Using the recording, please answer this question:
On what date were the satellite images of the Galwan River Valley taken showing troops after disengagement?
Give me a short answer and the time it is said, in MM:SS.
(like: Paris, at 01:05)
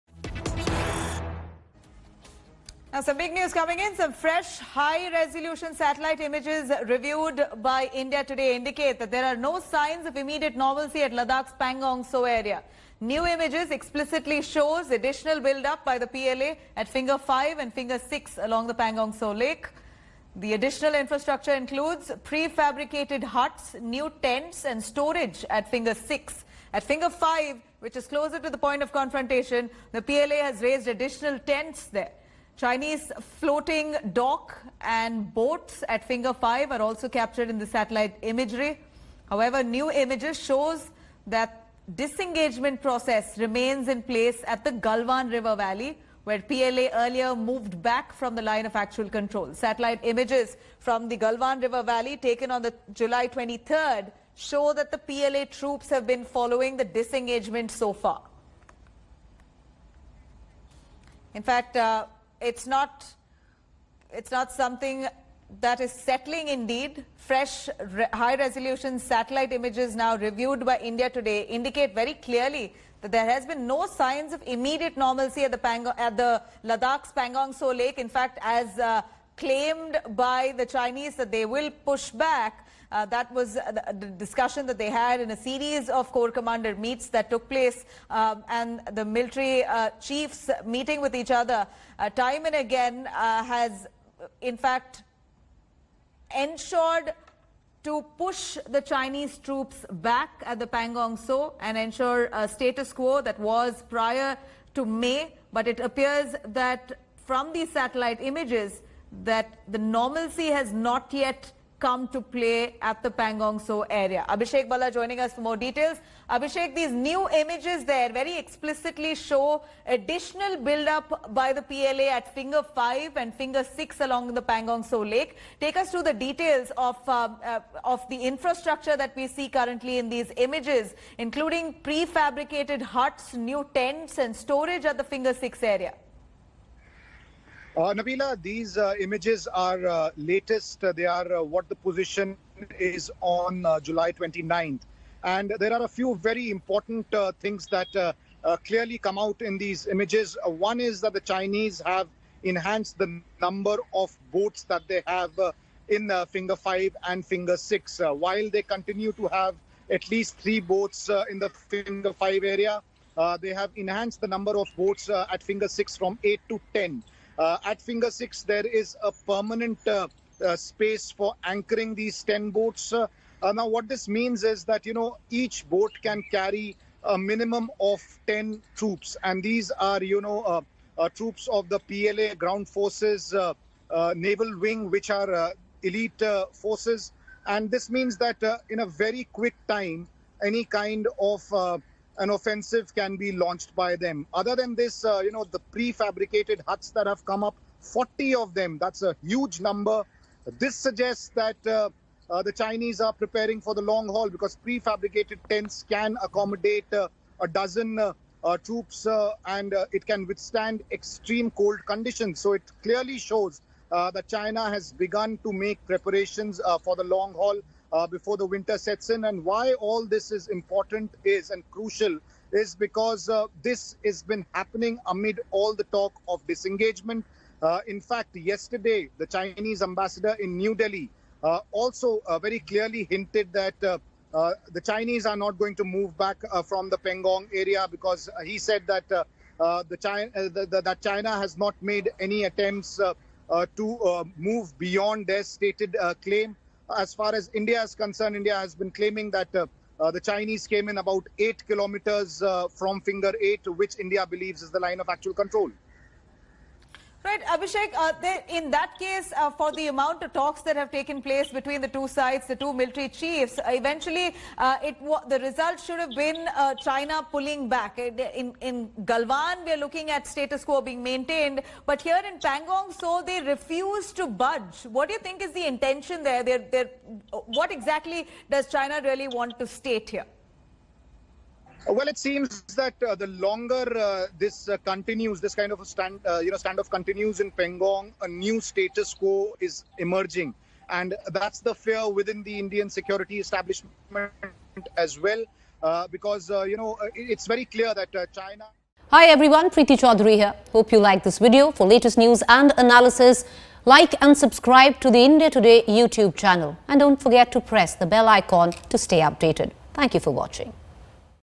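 July 23rd, at 00:52.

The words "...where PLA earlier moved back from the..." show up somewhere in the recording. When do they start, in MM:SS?
00:46.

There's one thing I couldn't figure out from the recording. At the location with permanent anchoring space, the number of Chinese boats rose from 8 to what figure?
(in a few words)
10.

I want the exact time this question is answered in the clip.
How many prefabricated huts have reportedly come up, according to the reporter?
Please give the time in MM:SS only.
03:17.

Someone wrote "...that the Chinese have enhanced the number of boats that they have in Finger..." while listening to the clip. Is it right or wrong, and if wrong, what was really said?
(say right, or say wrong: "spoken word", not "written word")
right.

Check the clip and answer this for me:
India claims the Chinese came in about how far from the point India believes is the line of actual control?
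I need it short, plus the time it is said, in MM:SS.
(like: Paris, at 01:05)
8 kilometers, at 04:11.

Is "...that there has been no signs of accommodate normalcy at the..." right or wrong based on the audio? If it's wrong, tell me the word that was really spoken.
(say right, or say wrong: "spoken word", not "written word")
wrong: "immediate", not "accommodate".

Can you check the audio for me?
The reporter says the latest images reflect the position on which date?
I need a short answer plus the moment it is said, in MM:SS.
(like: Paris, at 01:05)
July 29th, at 02:23.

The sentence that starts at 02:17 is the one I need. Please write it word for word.
Uh, Nabila, these uh, images are uh, latest.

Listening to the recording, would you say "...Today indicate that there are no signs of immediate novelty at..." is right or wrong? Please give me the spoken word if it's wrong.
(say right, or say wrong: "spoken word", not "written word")
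right.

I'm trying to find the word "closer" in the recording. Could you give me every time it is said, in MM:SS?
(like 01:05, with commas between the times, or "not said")
00:28.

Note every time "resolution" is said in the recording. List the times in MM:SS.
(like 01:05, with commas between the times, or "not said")
00:04, 01:08.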